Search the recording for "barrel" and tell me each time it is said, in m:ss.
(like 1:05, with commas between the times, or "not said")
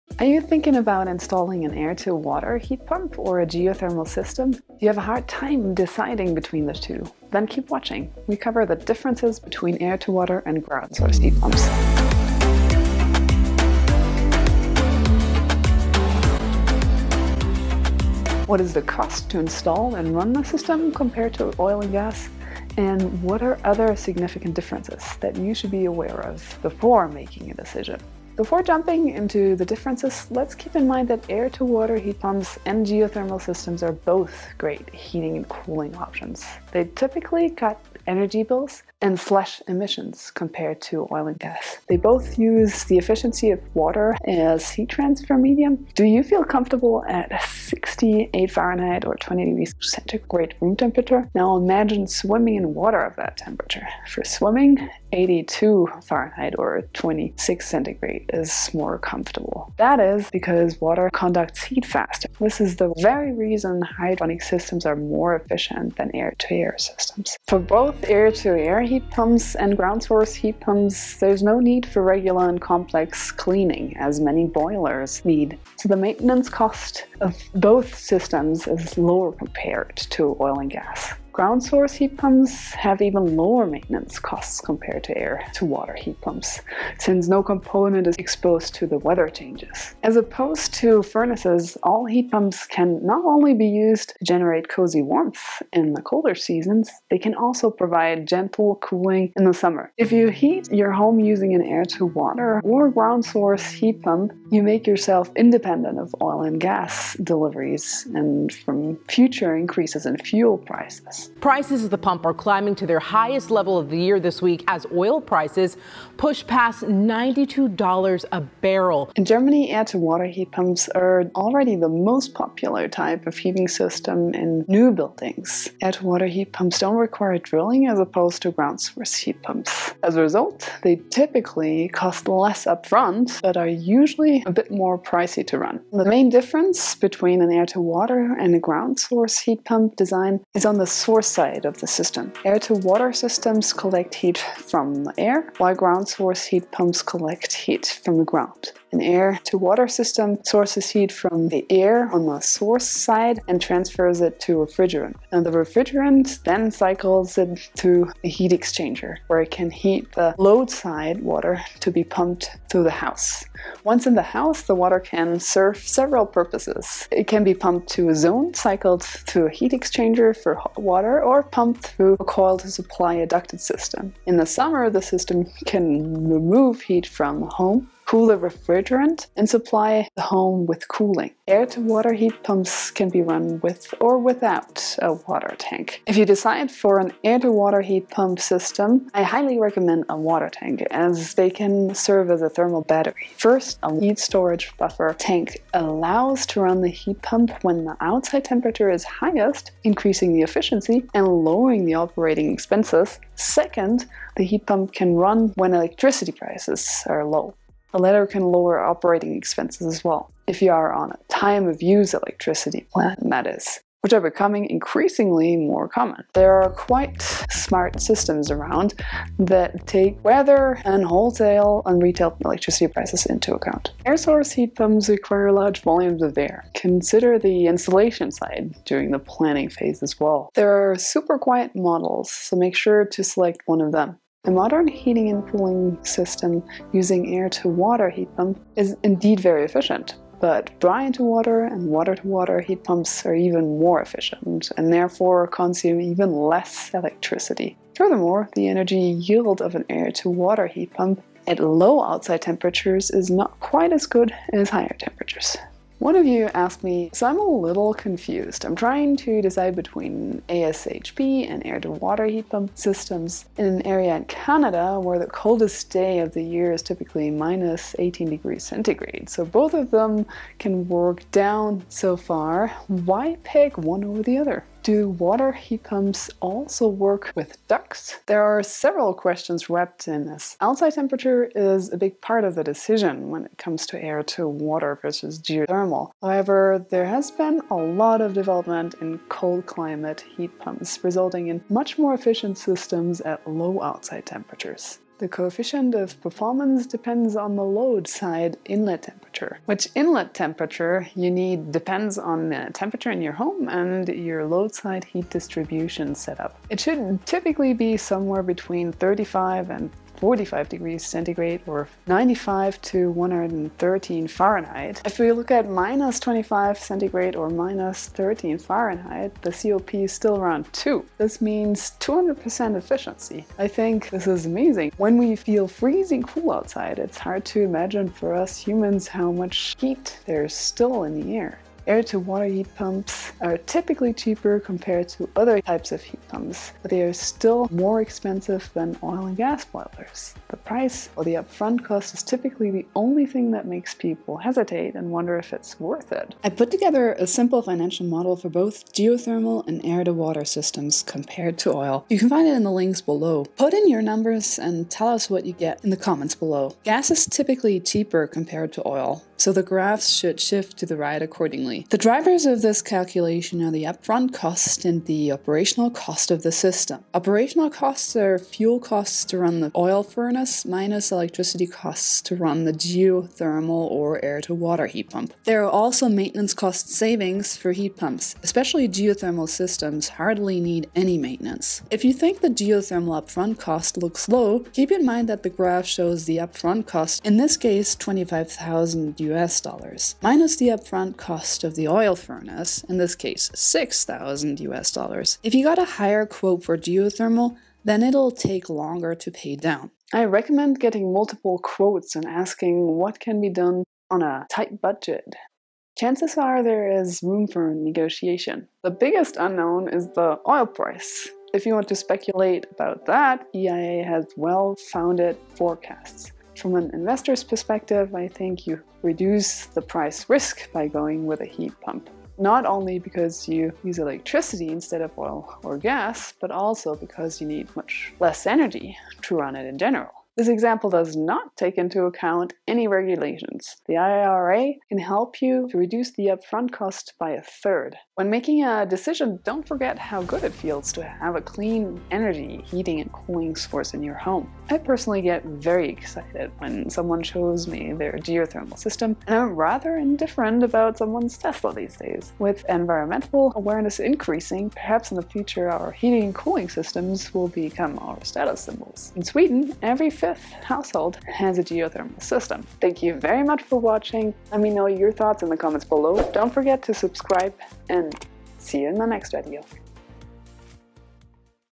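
1:58.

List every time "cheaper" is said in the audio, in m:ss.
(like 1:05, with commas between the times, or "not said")
5:34, 5:57.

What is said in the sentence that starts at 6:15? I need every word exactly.
There are also maintenance cost savings for heat pumps, especially geothermal systems hardly need any maintenance.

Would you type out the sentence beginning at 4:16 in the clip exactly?
One of you asked me, so I'm a little confused.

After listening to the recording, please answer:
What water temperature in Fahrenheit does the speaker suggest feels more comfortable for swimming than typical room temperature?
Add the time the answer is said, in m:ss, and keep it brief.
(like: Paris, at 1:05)
82 Fahrenheit, at 0:55.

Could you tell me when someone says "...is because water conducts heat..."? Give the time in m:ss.
0:59.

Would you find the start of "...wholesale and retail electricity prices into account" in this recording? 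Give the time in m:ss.
3:41.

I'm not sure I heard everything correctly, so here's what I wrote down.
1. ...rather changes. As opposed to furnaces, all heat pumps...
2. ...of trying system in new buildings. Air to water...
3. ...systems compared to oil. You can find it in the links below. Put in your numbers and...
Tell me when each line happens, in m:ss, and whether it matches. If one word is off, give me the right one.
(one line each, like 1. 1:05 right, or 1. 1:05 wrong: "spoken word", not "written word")
1. 1:28 wrong: "weather", not "rather"
2. 2:03 wrong: "heating", not "trying"
3. 5:50 right.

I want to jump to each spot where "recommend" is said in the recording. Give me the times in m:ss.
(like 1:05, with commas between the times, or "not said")
3:09, 6:40.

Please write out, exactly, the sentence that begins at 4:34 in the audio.
Do water heat pumps also work with ducts?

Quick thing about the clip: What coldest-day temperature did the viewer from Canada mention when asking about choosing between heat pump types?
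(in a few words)
-18 degrees centigrade.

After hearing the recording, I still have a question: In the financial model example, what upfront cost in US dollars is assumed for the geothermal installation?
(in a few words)
$25,000.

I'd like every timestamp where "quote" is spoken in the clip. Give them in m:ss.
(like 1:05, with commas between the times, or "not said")
6:36, 6:41.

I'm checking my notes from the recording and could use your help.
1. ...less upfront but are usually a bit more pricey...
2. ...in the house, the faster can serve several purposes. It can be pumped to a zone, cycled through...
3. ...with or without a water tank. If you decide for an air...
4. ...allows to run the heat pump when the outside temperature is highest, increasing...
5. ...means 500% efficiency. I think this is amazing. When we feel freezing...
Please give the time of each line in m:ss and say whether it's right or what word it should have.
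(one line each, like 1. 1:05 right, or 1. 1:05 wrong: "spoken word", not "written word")
1. 2:12 right
2. 2:44 wrong: "water", not "faster"
3. 3:03 right
4. 3:15 right
5. 5:21 wrong: "200", not "500".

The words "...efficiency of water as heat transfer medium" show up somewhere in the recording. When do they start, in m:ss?
0:42.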